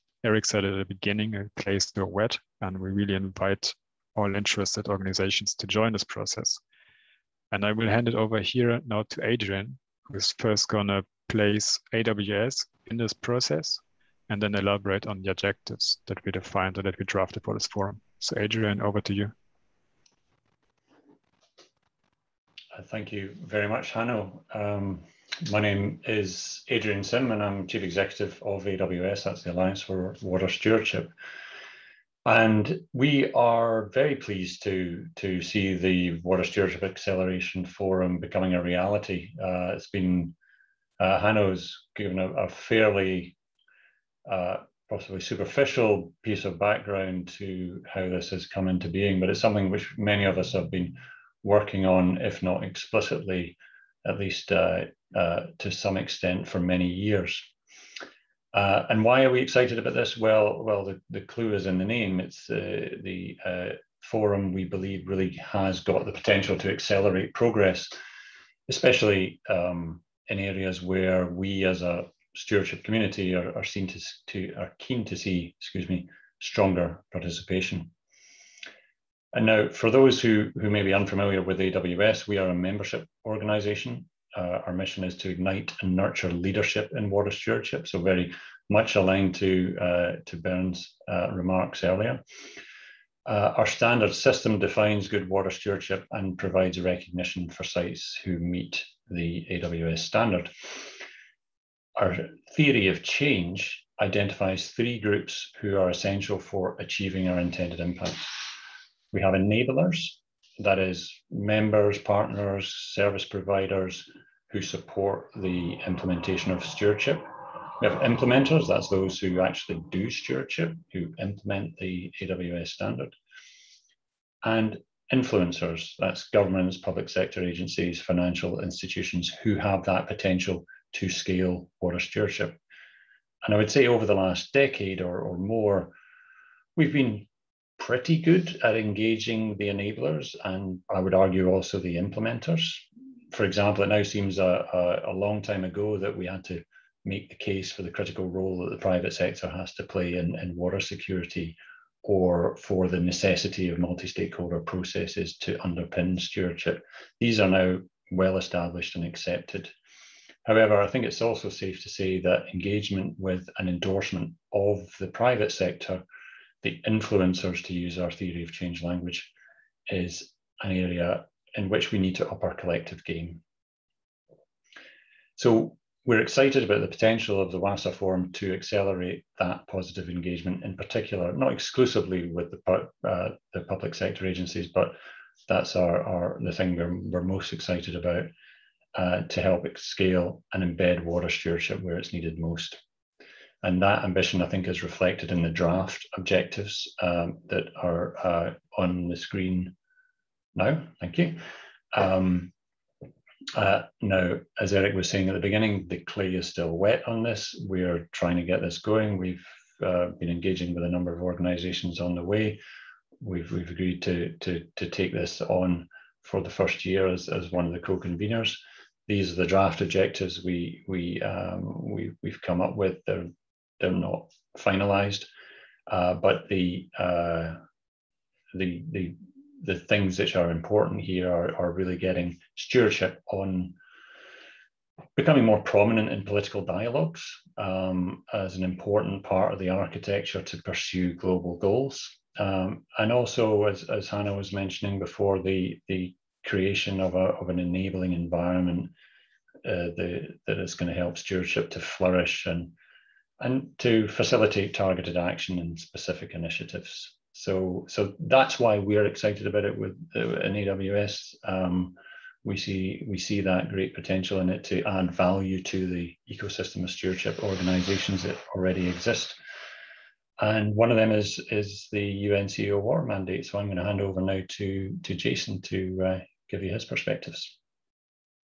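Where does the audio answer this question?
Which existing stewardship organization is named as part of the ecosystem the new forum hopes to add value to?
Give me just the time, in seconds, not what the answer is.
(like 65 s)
272 s.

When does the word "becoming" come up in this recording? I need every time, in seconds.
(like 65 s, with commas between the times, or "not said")
38 s, 235 s.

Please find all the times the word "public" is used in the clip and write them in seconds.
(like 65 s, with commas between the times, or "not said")
126 s, 183 s.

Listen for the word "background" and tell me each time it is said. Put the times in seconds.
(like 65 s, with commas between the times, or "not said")
46 s.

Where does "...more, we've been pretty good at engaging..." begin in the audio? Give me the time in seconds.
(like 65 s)
135 s.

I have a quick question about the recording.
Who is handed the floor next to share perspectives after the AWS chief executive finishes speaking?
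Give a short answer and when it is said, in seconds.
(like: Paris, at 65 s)
Jason, at 275 s.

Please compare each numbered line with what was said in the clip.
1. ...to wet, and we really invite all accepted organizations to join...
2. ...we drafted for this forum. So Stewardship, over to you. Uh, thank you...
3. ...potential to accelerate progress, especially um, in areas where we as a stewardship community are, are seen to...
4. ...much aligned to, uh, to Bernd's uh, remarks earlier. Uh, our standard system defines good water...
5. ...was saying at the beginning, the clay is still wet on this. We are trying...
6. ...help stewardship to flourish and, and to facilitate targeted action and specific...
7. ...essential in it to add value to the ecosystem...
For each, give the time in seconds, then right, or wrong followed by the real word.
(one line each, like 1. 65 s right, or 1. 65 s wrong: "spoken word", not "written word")
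1. 1 s wrong: "interested", not "accepted"
2. 16 s wrong: "Adrian", not "Stewardship"
3. 66 s right
4. 88 s right
5. 204 s right
6. 250 s right
7. 263 s wrong: "potential", not "essential".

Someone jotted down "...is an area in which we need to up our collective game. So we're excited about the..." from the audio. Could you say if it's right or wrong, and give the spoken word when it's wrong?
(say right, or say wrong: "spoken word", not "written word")
right.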